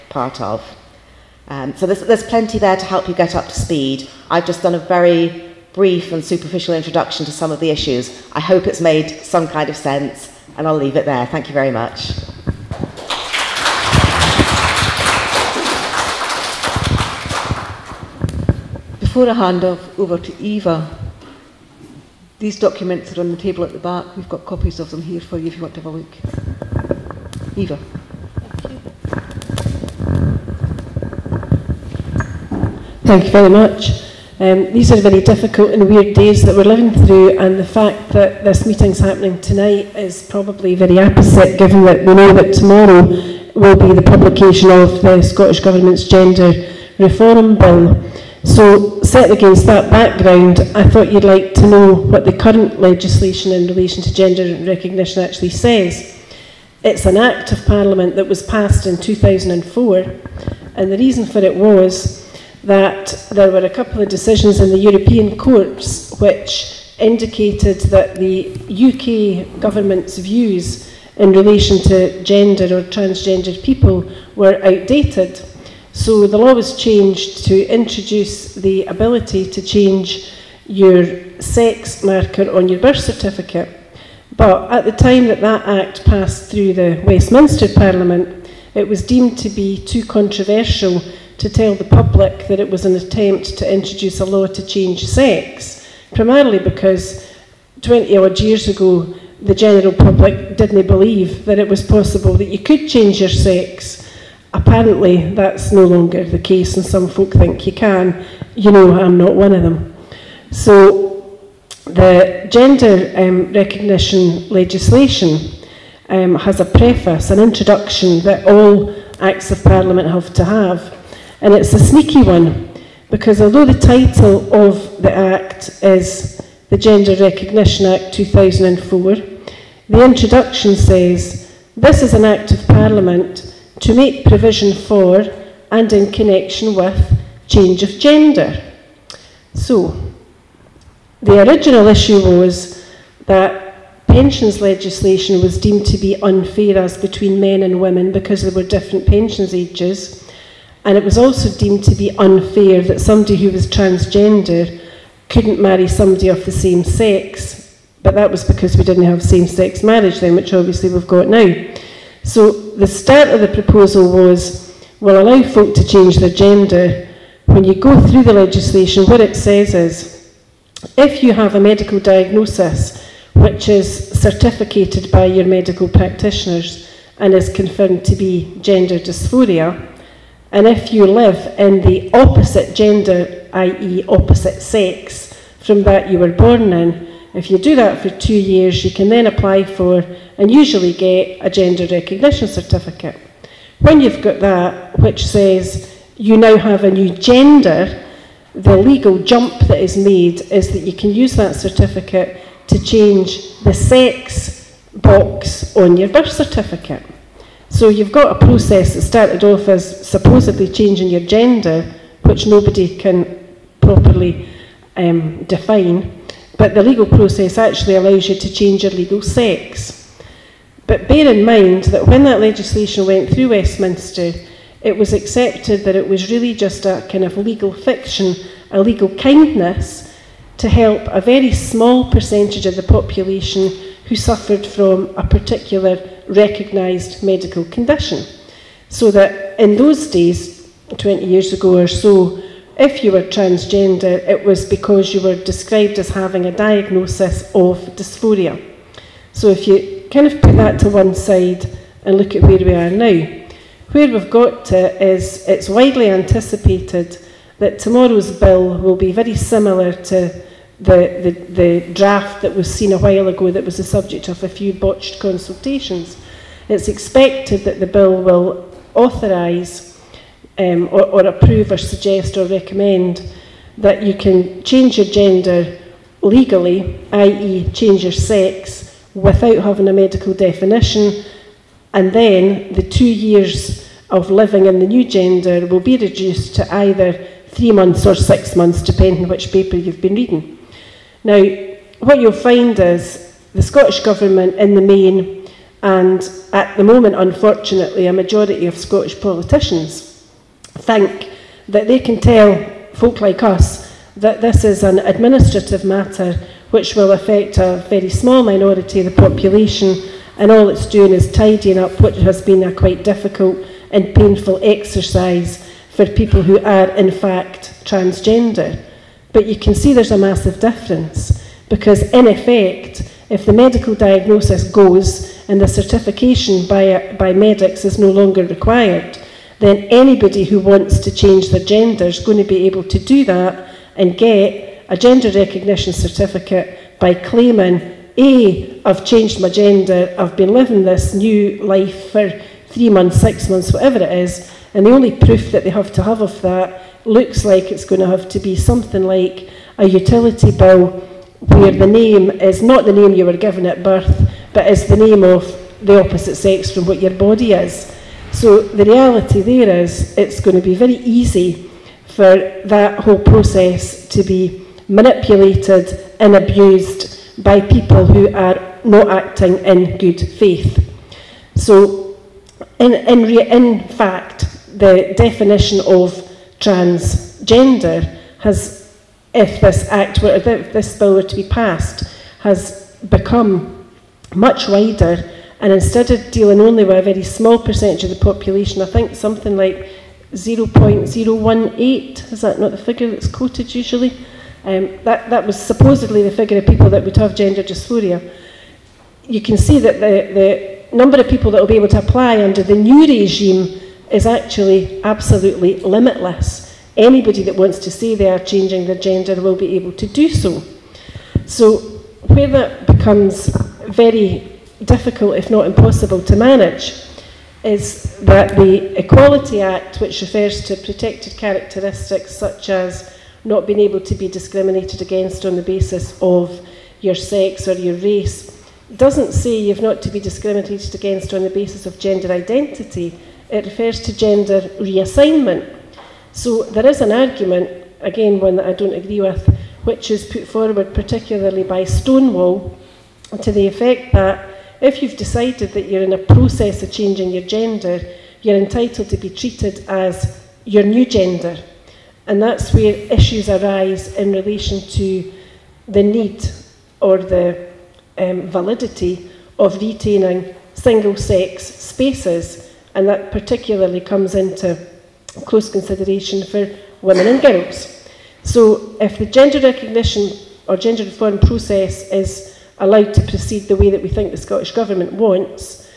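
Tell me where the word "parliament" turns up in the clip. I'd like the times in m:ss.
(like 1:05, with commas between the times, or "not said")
0:57, 1:27, 1:59, 2:12.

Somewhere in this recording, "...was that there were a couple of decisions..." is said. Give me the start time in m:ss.
1:01.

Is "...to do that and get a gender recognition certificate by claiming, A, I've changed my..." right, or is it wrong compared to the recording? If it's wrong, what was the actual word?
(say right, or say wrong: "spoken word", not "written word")
right.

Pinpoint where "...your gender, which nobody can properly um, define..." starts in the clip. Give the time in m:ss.
3:31.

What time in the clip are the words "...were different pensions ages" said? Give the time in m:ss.
2:28.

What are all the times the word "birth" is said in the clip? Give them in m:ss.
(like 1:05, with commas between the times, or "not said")
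1:22, 3:26, 5:53.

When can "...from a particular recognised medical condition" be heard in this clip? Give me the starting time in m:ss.
3:54.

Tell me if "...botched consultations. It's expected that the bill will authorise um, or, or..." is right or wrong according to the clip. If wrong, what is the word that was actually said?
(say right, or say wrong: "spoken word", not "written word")
right.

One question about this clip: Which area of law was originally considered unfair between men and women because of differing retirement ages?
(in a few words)
Pensions legislation.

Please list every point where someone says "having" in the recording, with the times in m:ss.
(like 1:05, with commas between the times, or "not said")
4:06, 4:39.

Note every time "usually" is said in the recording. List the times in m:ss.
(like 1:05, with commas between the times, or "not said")
3:10, 6:33.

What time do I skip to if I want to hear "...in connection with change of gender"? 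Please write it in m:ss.
2:15.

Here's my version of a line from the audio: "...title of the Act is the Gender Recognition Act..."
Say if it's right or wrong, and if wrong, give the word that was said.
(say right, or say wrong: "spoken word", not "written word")
right.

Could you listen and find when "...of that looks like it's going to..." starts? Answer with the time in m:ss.
5:46.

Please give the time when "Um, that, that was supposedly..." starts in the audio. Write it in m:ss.
6:34.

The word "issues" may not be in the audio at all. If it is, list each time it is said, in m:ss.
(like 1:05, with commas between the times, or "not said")
0:07, 2:21, 7:33.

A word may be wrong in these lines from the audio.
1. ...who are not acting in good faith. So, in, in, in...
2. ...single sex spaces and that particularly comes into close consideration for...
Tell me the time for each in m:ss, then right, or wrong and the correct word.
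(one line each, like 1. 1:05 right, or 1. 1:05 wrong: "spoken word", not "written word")
1. 6:08 right
2. 7:40 right.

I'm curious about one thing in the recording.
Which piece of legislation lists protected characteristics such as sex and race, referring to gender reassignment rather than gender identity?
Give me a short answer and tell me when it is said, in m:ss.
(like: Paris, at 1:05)
The Equality Act, at 6:58.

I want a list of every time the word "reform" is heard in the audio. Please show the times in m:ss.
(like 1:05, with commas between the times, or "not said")
0:46, 7:51.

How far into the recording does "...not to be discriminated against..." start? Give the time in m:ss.
7:09.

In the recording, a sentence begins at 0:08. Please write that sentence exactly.
I hope it's made some kind of sense, and I'll leave it there.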